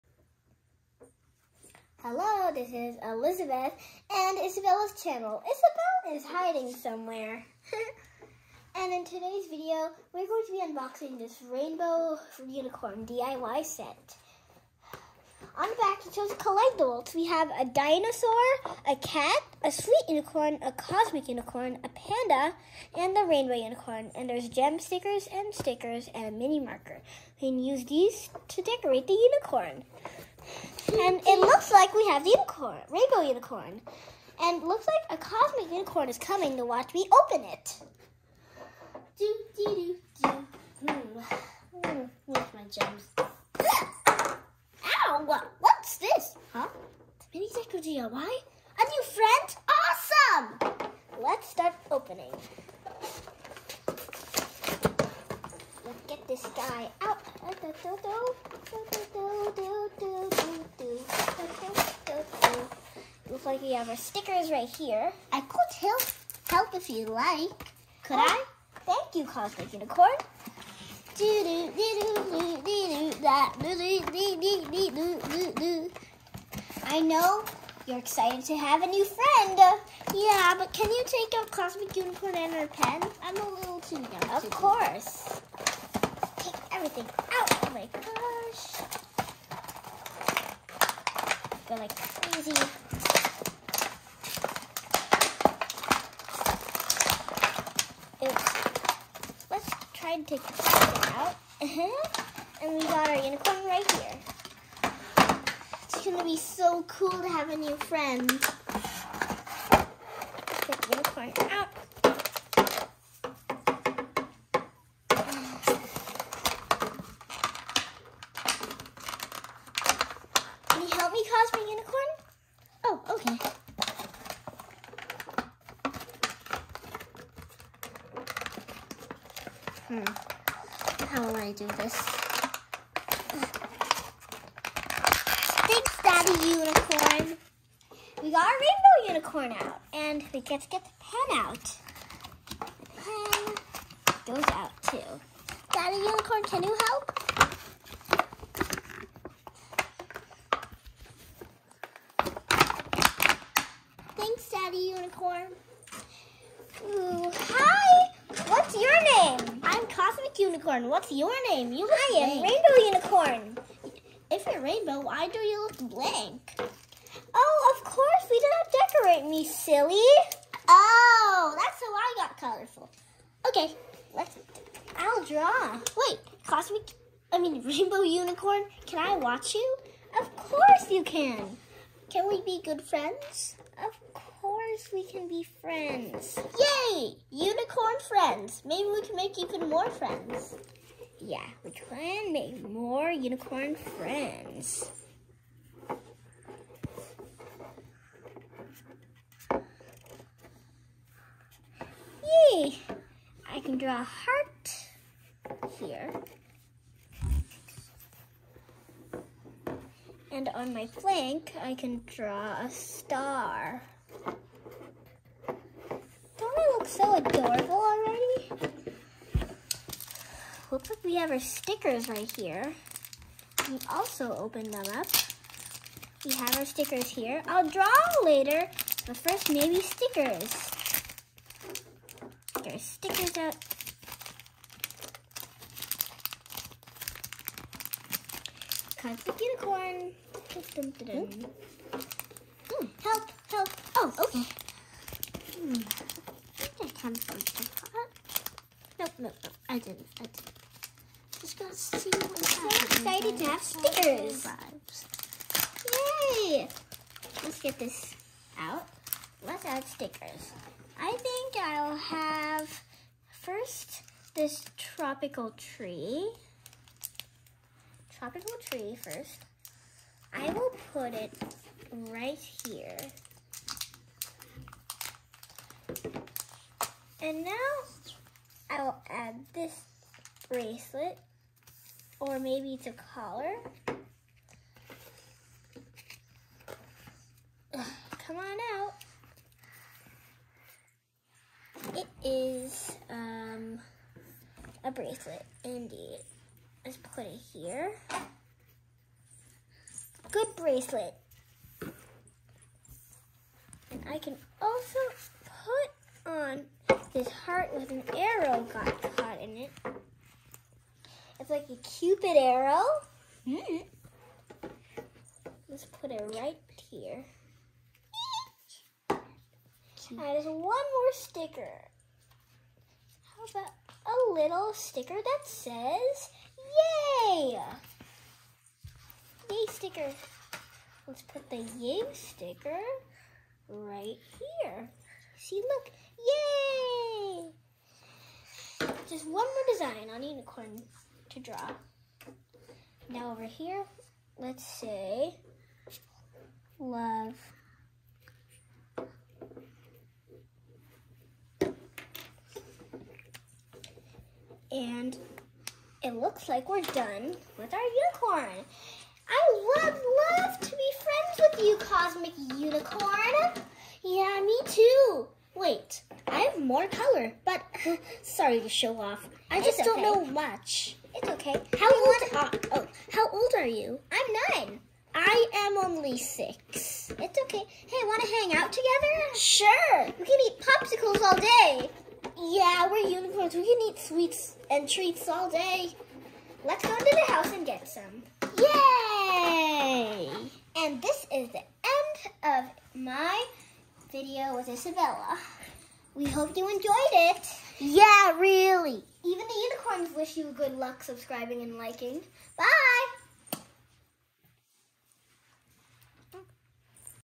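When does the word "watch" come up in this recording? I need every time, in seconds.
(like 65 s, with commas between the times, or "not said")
36 s, 179 s.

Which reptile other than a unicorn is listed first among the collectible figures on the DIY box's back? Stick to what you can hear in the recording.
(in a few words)
Dinosaur.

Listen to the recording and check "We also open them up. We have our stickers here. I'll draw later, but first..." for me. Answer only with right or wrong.
right.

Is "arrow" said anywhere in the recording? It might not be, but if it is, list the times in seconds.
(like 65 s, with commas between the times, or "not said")
308 s, 312 s.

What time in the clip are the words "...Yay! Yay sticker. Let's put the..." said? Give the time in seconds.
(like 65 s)
327 s.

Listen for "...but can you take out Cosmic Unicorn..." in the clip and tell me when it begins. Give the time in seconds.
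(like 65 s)
80 s.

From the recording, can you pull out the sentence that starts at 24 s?
And there's gem stickers and stickers and a mini marker.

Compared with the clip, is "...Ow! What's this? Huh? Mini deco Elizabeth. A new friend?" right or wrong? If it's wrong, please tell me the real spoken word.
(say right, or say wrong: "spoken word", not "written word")
wrong: "DIY", not "Elizabeth".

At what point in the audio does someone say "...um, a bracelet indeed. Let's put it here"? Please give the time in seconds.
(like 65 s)
293 s.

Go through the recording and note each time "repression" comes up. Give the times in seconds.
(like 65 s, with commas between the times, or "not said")
not said.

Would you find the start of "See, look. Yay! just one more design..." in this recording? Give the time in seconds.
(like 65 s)
335 s.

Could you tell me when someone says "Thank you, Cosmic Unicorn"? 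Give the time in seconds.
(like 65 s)
68 s.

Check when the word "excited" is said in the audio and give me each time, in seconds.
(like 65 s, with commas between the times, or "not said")
77 s, 252 s.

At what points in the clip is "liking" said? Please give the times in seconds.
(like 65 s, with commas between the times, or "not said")
401 s.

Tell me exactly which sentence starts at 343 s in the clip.
Now over here, let's say love.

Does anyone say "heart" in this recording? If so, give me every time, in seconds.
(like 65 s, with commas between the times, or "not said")
204 s, 307 s.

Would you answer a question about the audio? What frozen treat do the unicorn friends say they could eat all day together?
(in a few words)
Popsicles.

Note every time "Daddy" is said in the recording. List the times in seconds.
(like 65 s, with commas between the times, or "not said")
136 s, 145 s, 154 s.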